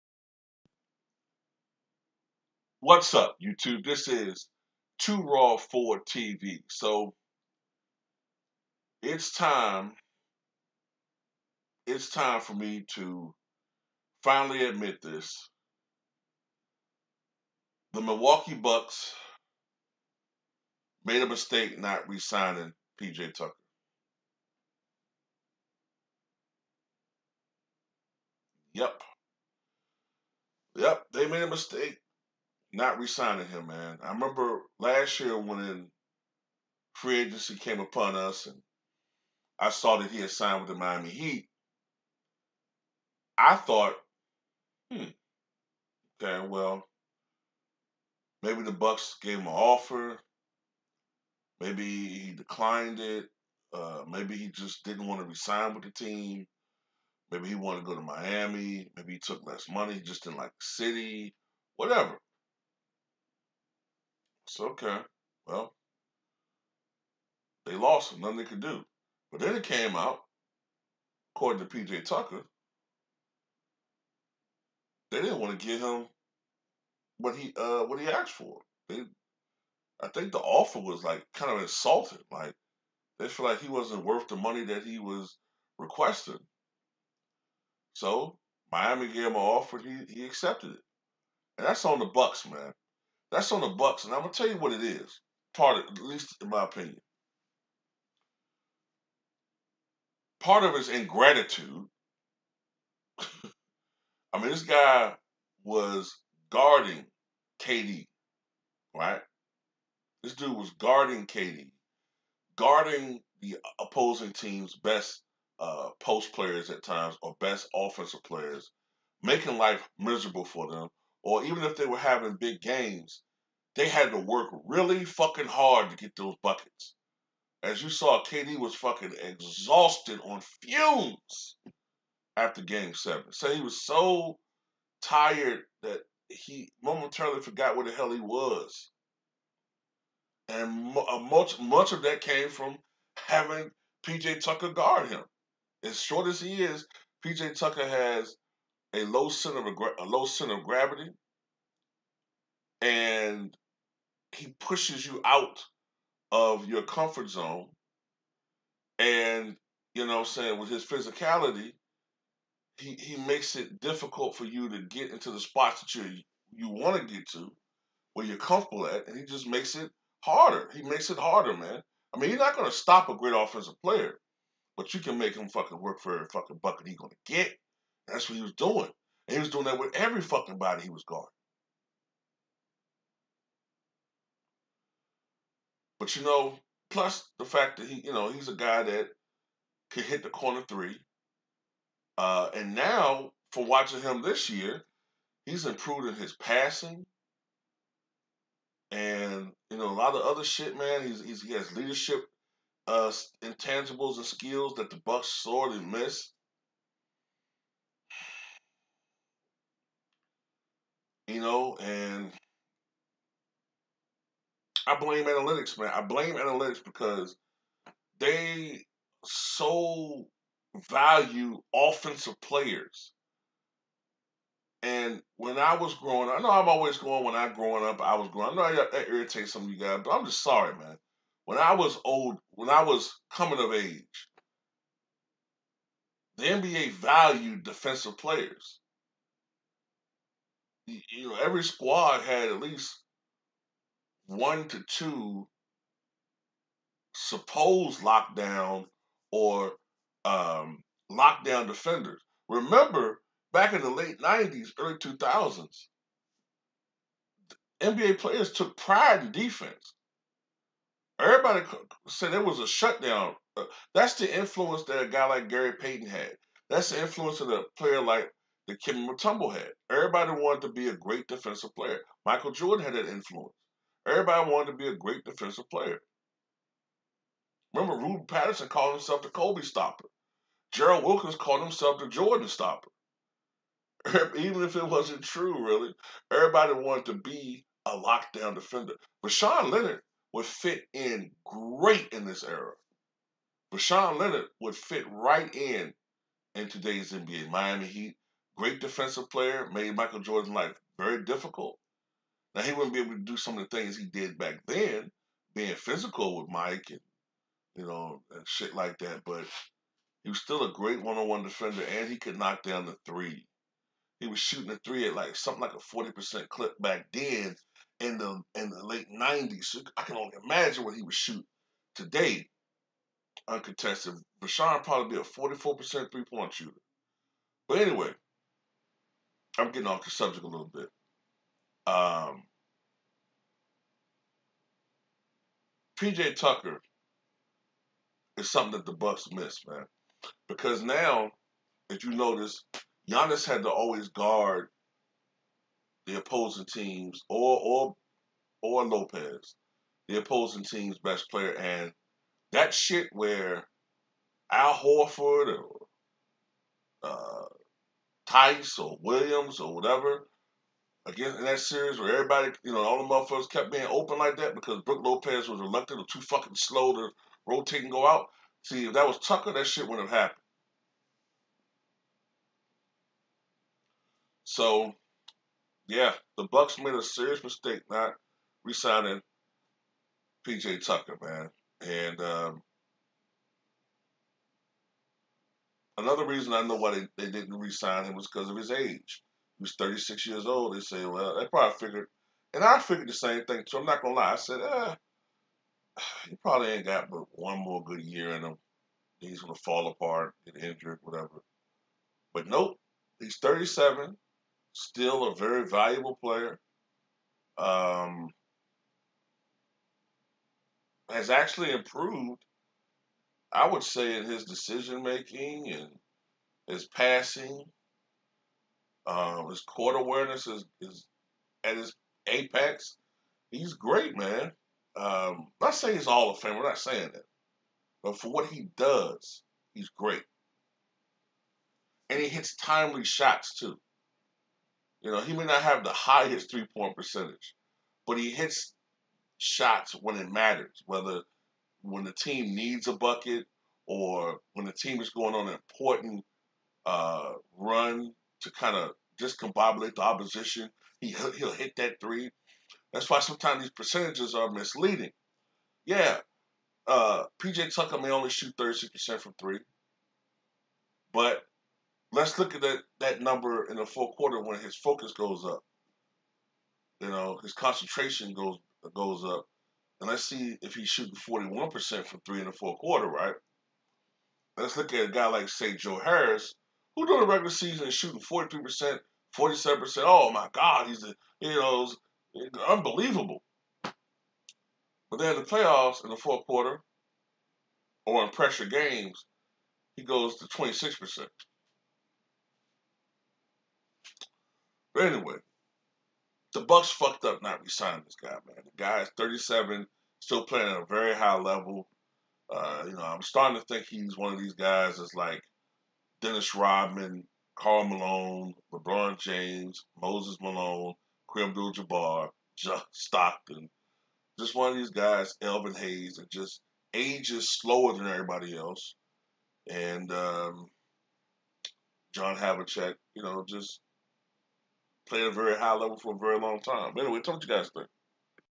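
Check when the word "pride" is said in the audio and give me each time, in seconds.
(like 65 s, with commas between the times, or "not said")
258 s.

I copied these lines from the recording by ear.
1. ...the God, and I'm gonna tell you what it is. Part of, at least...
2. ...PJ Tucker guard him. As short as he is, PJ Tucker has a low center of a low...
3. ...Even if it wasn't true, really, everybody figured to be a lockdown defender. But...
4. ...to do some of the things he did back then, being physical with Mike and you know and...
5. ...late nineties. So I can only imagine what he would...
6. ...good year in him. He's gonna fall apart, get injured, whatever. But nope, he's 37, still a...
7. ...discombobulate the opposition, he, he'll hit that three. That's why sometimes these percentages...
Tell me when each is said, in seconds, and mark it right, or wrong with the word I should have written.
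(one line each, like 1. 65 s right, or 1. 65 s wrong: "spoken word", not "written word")
1. 93 s wrong: "Bucks", not "God"
2. 144 s right
3. 284 s wrong: "wanted", not "figured"
4. 303 s right
5. 318 s right
6. 397 s right
7. 449 s right.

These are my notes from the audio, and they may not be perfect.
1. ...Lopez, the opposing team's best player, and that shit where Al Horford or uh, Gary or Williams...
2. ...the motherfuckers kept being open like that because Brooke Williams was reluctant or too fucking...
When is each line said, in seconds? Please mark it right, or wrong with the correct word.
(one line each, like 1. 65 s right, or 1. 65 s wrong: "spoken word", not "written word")
1. 348 s wrong: "Tice", not "Gary"
2. 363 s wrong: "Lopez", not "Williams".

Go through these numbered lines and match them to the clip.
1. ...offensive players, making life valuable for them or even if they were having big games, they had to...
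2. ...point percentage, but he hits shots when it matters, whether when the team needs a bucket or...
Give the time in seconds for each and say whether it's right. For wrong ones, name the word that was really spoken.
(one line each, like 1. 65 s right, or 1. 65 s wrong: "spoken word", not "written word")
1. 117 s wrong: "miserable", not "valuable"
2. 436 s right.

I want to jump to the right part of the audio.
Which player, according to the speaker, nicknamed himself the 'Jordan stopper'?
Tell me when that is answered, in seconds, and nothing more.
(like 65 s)
280 s.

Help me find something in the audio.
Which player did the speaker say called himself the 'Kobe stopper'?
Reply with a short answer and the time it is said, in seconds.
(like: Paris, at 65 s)
Ruben Patterson, at 277 s.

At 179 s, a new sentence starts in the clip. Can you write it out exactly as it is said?
And he was doing that with every fucking body he was guarding.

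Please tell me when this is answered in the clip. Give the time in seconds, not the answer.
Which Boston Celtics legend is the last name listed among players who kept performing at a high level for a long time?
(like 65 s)
522 s.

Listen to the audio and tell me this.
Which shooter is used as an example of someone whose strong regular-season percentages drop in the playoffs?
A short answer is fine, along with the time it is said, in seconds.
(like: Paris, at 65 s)
Joe Harris, at 475 s.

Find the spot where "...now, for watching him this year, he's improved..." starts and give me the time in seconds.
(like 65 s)
192 s.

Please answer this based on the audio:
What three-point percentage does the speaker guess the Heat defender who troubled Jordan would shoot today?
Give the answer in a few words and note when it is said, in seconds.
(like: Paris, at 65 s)
44%, at 325 s.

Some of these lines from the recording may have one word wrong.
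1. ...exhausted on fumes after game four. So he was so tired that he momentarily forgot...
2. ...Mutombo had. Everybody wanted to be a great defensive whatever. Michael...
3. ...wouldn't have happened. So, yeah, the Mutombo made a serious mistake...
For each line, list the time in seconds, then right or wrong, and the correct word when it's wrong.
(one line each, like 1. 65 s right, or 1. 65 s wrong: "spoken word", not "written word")
1. 129 s wrong: "seven", not "four"
2. 269 s wrong: "player", not "whatever"
3. 369 s wrong: "Bucks", not "Mutombo".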